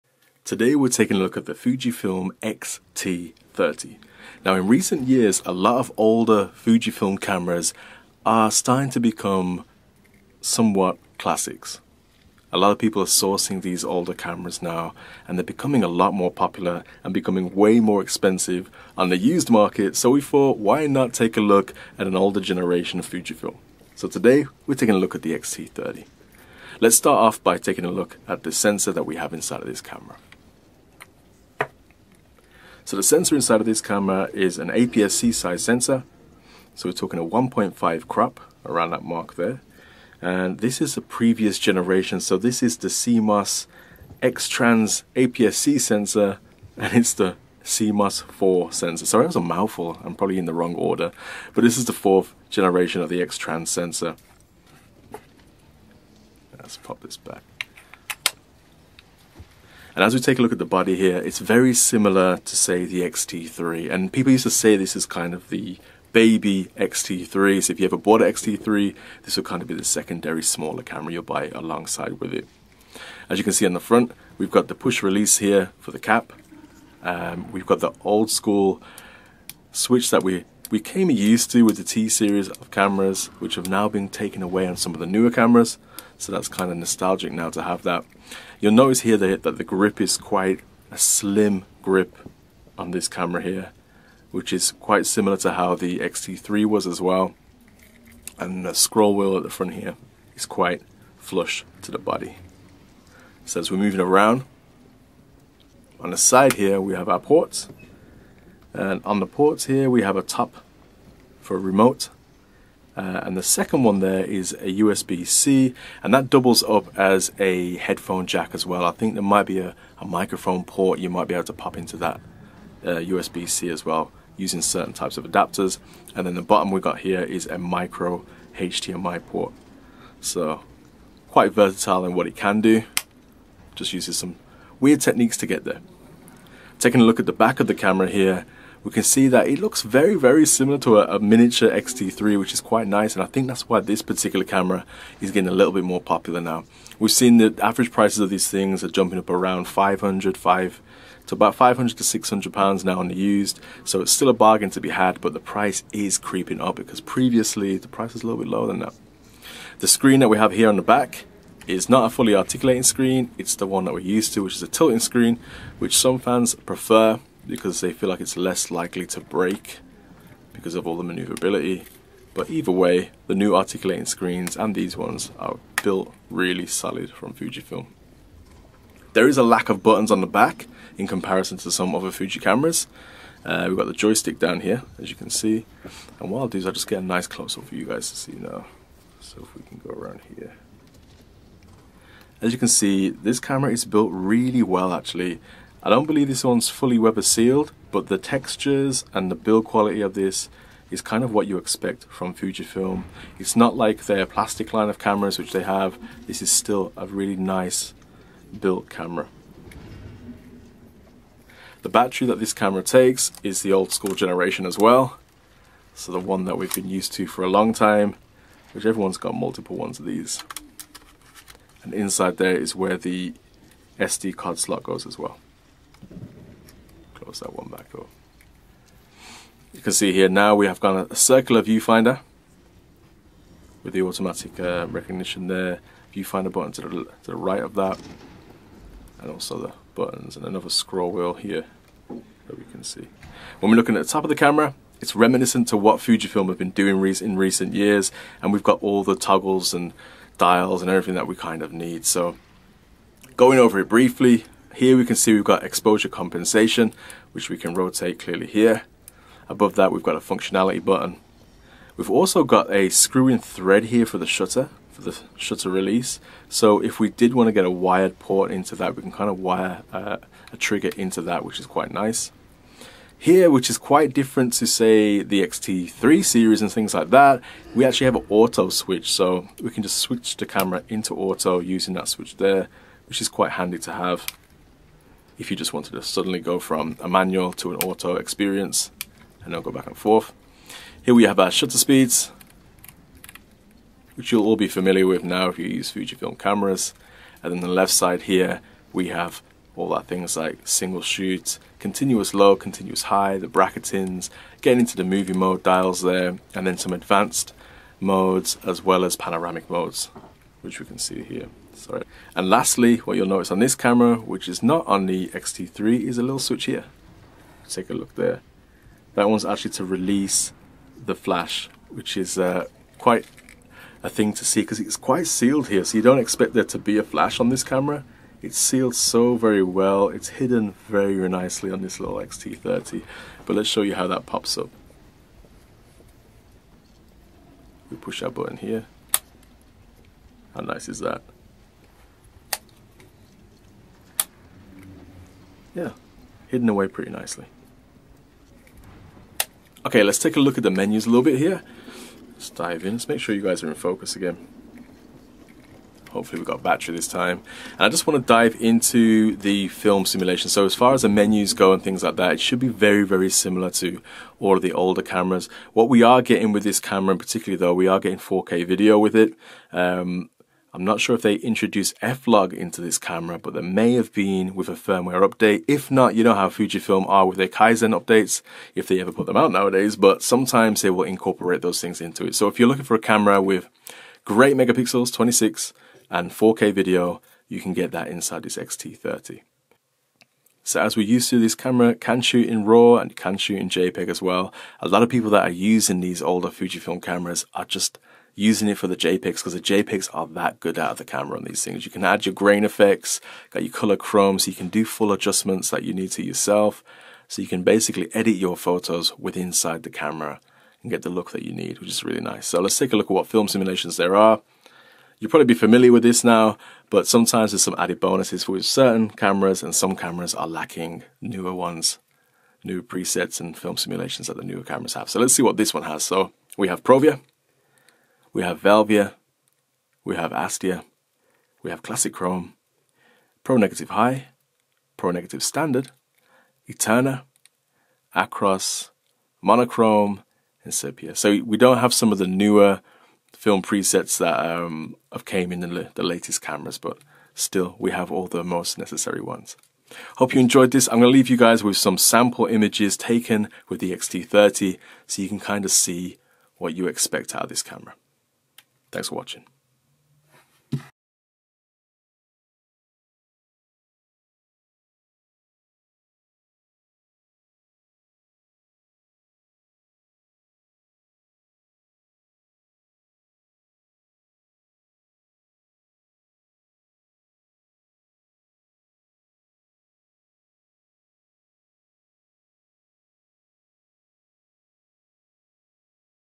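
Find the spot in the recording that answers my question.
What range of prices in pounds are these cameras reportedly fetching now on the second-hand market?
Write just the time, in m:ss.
2:31.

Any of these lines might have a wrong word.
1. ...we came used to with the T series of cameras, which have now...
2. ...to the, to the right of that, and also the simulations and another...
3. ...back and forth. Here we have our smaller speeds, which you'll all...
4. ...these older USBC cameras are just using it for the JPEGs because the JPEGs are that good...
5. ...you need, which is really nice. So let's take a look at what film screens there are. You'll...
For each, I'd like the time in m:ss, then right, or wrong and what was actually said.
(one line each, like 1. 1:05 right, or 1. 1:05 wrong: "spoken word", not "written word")
1. 1:20 right
2. 3:56 wrong: "buttons", not "simulations"
3. 4:49 wrong: "shutter", not "smaller"
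4. 6:35 wrong: "Fujifilm", not "USBC"
5. 6:51 wrong: "simulations", not "screens".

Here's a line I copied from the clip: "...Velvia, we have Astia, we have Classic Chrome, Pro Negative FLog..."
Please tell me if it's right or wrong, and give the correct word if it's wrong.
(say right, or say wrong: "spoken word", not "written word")
wrong: "High", not "FLog".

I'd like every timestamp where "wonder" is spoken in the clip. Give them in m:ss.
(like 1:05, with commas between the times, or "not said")
not said.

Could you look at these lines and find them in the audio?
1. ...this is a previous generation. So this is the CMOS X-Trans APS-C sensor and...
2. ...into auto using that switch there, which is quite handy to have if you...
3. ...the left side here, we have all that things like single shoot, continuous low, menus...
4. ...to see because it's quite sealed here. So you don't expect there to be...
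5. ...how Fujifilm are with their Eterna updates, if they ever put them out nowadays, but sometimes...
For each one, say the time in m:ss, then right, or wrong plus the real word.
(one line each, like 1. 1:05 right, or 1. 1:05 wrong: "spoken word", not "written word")
1. 0:40 right
2. 4:40 right
3. 4:57 wrong: "continuous", not "menus"
4. 5:24 right
5. 6:16 wrong: "Kaizen", not "Eterna".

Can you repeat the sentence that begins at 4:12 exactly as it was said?
So going over it briefly, here we can see we've got exposure compensation, which we can rotate clearly here.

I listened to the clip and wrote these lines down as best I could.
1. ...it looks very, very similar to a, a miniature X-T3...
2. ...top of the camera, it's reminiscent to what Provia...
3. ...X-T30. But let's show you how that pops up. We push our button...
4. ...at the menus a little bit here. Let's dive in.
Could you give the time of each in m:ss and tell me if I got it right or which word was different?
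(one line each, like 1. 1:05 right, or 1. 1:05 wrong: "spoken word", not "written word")
1. 2:19 right
2. 4:04 wrong: "Fujifilm", not "Provia"
3. 5:32 right
4. 5:50 right.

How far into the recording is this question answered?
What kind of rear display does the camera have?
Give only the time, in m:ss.
2:44.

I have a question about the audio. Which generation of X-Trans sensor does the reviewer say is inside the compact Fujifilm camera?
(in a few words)
4th generation.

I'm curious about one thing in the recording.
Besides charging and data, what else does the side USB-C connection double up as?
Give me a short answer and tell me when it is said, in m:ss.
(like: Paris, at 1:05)
Headphone jack, at 1:57.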